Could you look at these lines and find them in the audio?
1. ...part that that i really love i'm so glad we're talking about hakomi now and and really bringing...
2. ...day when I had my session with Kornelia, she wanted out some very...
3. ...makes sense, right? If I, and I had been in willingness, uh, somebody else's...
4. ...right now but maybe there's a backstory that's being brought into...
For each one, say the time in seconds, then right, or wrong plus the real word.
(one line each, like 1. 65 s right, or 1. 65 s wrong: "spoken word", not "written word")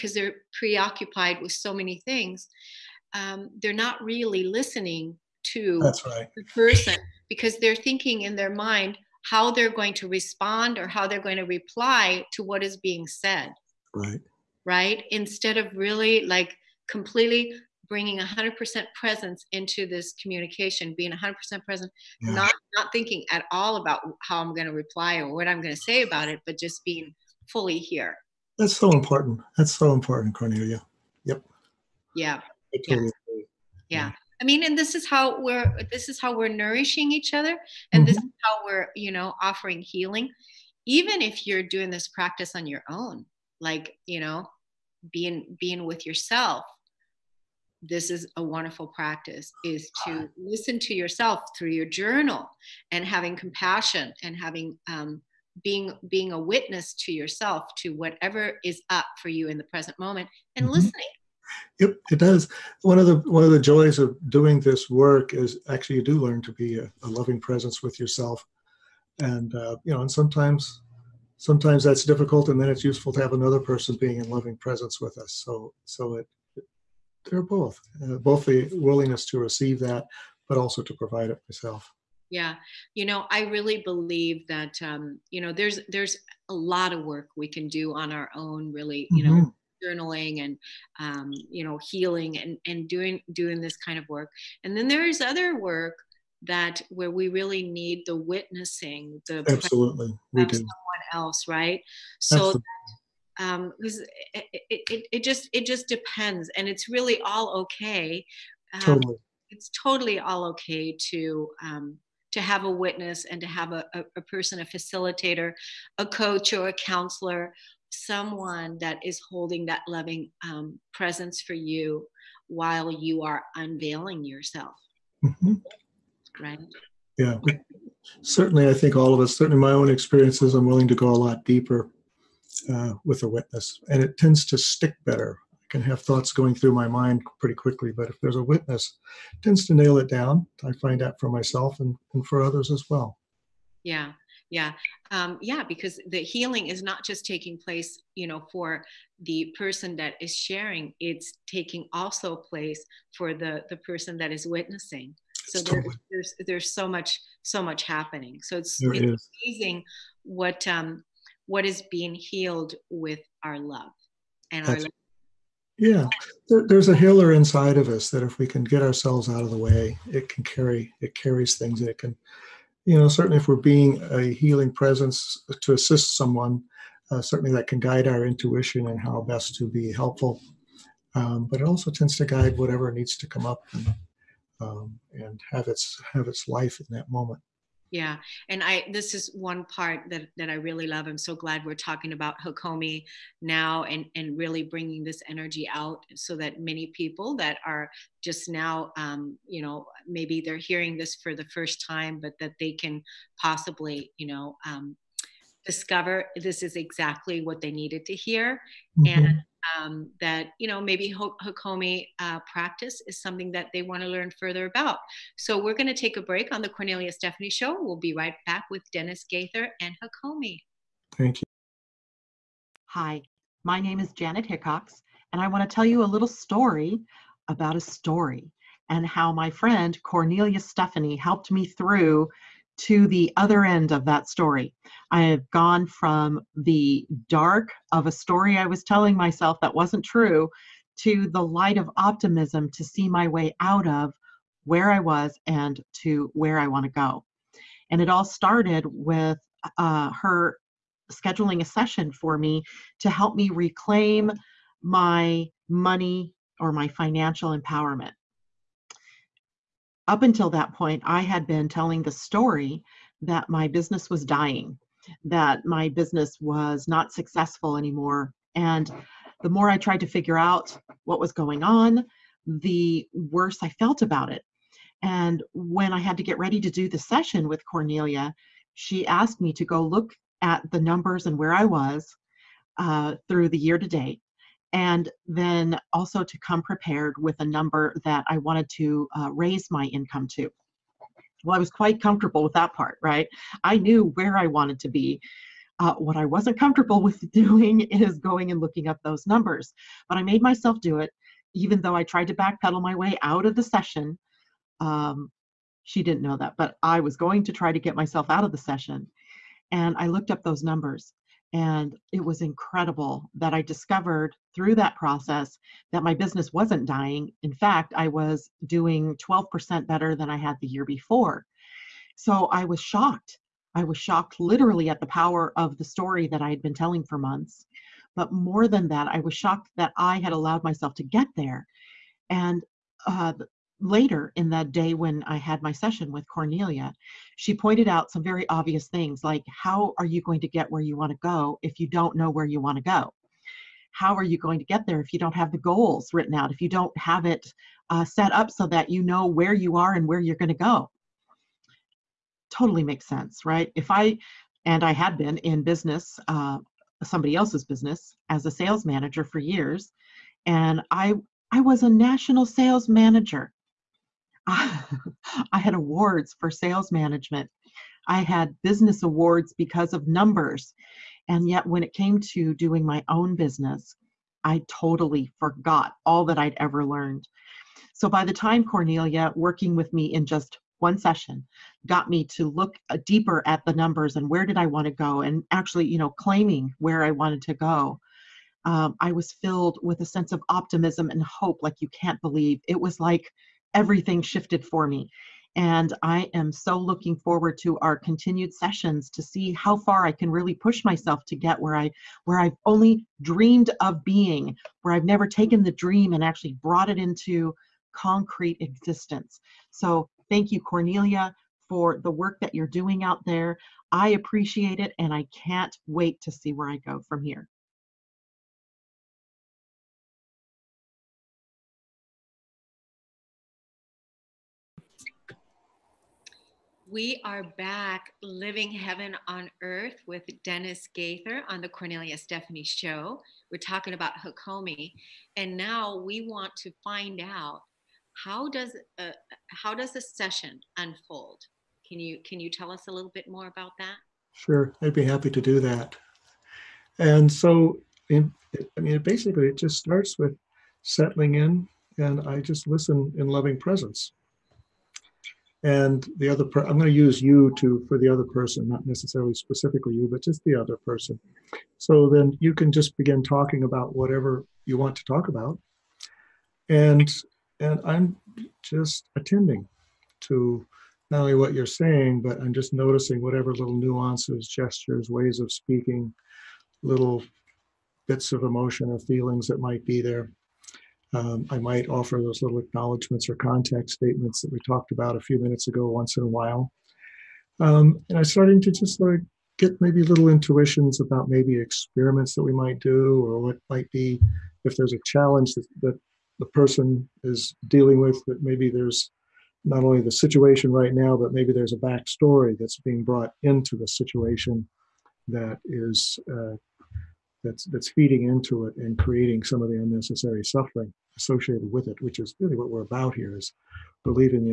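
1. 189 s right
2. 334 s wrong: "pointed", not "wanted"
3. 352 s wrong: "business", not "willingness"
4. 500 s right.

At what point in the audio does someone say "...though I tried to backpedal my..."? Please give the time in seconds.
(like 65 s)
301 s.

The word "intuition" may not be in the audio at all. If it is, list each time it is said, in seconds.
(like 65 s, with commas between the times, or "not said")
178 s, 490 s.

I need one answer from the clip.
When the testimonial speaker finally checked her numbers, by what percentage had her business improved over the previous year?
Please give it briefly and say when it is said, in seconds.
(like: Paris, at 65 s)
12%, at 319 s.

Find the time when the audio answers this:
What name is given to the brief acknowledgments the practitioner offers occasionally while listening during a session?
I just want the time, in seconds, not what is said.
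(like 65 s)
483 s.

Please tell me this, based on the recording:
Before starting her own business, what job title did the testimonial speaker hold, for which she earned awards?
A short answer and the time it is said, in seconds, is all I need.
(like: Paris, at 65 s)
national sales manager, at 361 s.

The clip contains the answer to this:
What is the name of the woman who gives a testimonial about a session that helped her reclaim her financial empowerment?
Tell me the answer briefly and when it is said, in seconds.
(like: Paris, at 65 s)
Janet Hickox, at 224 s.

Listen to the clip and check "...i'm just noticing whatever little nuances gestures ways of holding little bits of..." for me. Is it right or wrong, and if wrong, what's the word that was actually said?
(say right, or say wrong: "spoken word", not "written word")
wrong: "speaking", not "holding".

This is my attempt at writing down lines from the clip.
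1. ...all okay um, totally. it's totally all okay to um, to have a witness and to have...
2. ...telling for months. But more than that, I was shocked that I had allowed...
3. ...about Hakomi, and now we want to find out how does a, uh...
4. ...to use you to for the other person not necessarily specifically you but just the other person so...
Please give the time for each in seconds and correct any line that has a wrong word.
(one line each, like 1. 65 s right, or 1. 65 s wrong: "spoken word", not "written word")
1. 107 s right
2. 326 s right
3. 433 s right
4. 456 s right.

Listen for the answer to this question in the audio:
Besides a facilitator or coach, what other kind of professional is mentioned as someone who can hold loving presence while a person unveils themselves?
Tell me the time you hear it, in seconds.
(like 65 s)
116 s.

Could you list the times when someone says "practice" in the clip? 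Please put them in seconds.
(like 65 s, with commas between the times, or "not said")
42 s, 48 s, 212 s.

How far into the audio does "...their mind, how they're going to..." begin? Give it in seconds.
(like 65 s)
8 s.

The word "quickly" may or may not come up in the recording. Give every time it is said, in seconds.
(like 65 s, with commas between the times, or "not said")
137 s.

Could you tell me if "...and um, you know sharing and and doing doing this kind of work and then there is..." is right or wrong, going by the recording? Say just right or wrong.
wrong.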